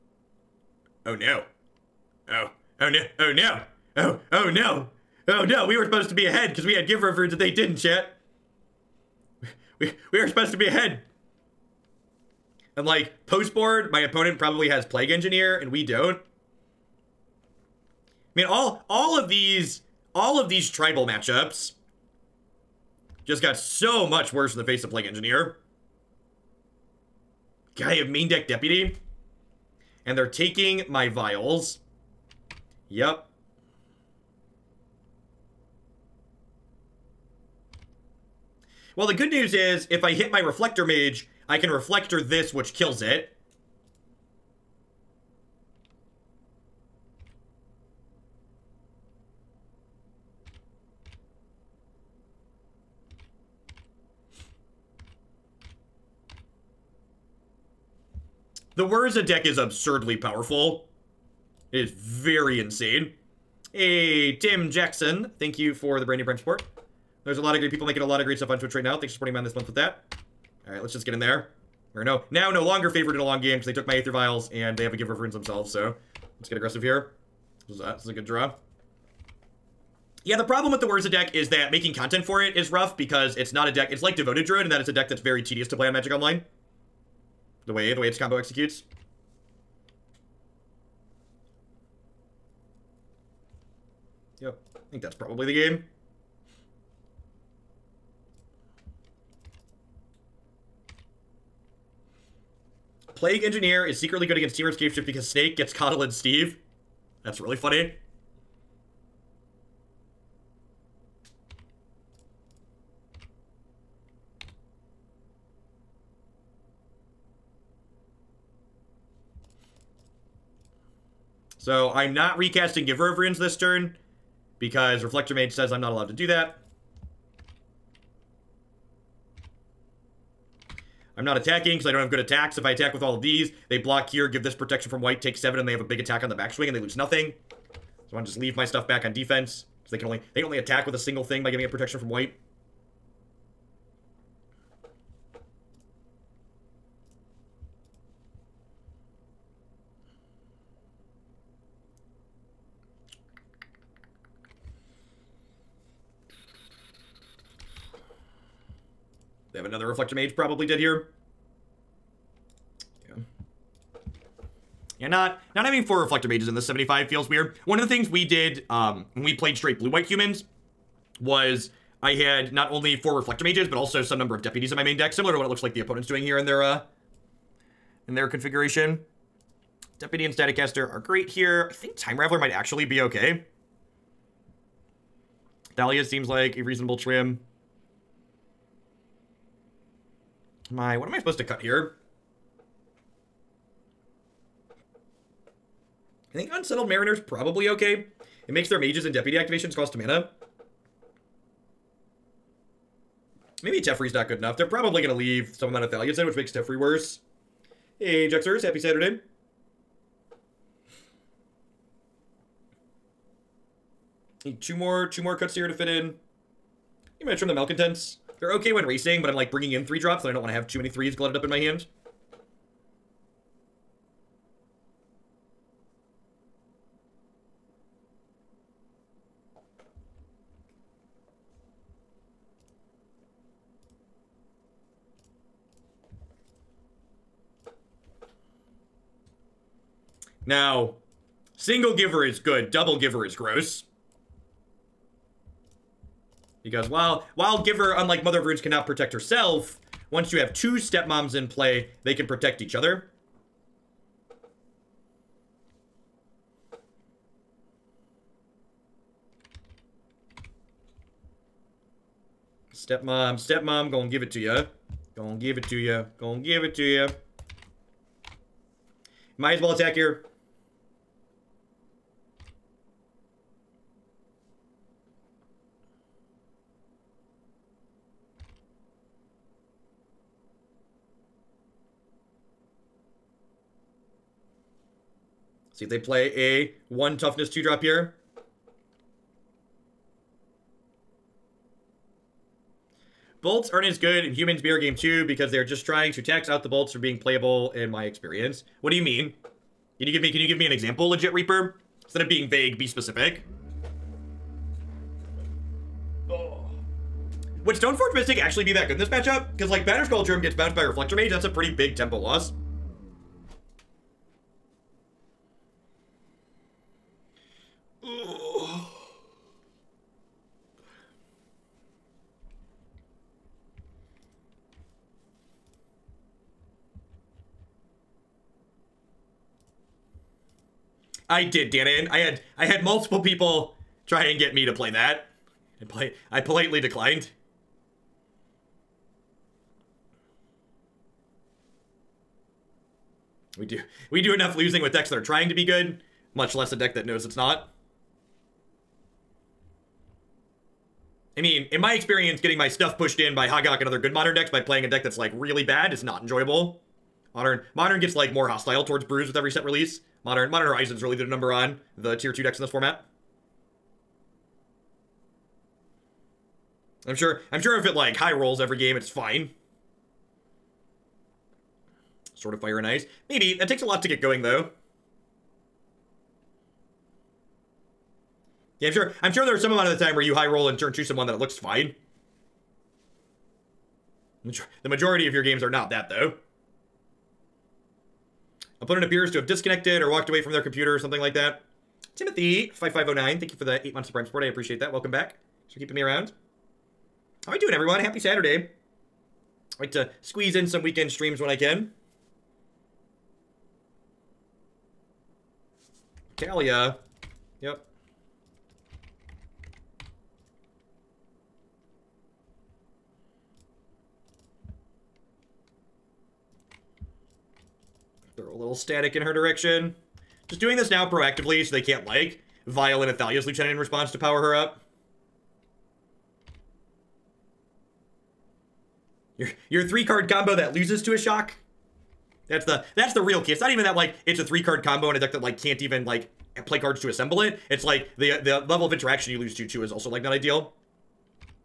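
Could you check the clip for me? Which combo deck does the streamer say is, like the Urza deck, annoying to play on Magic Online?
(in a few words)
Devoted Druid.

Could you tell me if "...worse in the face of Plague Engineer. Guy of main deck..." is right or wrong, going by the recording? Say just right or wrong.
right.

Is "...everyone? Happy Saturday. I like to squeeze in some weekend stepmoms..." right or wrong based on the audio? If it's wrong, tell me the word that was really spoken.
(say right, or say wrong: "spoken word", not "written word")
wrong: "streams", not "stepmoms".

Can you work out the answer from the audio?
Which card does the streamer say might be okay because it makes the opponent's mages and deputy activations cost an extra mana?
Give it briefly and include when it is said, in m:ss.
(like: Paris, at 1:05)
Unsettled Mariner, at 3:16.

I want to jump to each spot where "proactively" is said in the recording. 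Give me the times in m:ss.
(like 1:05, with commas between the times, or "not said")
7:01.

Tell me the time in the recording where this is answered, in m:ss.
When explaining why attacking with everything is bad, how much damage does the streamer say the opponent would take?
2:15.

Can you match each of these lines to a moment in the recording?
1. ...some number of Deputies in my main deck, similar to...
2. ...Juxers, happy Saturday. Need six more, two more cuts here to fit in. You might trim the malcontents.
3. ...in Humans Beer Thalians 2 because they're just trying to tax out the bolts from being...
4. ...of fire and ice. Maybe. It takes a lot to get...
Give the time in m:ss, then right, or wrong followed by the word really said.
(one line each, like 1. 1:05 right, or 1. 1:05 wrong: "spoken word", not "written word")
1. 2:54 right
2. 3:28 wrong: "two", not "six"
3. 4:54 wrong: "Game", not "Thalians"
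4. 6:12 right.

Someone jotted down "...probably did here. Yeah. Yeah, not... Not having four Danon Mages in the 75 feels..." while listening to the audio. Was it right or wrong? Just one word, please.
wrong.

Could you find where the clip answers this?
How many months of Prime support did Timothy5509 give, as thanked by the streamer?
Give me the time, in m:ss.
6:33.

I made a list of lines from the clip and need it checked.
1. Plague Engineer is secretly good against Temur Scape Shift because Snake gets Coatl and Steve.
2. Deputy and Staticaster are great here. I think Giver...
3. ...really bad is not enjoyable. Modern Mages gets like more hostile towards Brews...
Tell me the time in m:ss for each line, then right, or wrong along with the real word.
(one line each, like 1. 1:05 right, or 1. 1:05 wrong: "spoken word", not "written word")
1. 1:43 right
2. 2:59 wrong: "Time", not "Giver"
3. 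5:55 wrong: "Modern", not "Mages".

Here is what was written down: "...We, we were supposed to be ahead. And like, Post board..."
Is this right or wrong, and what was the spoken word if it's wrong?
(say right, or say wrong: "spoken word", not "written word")
right.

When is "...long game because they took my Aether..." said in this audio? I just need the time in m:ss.
1:13.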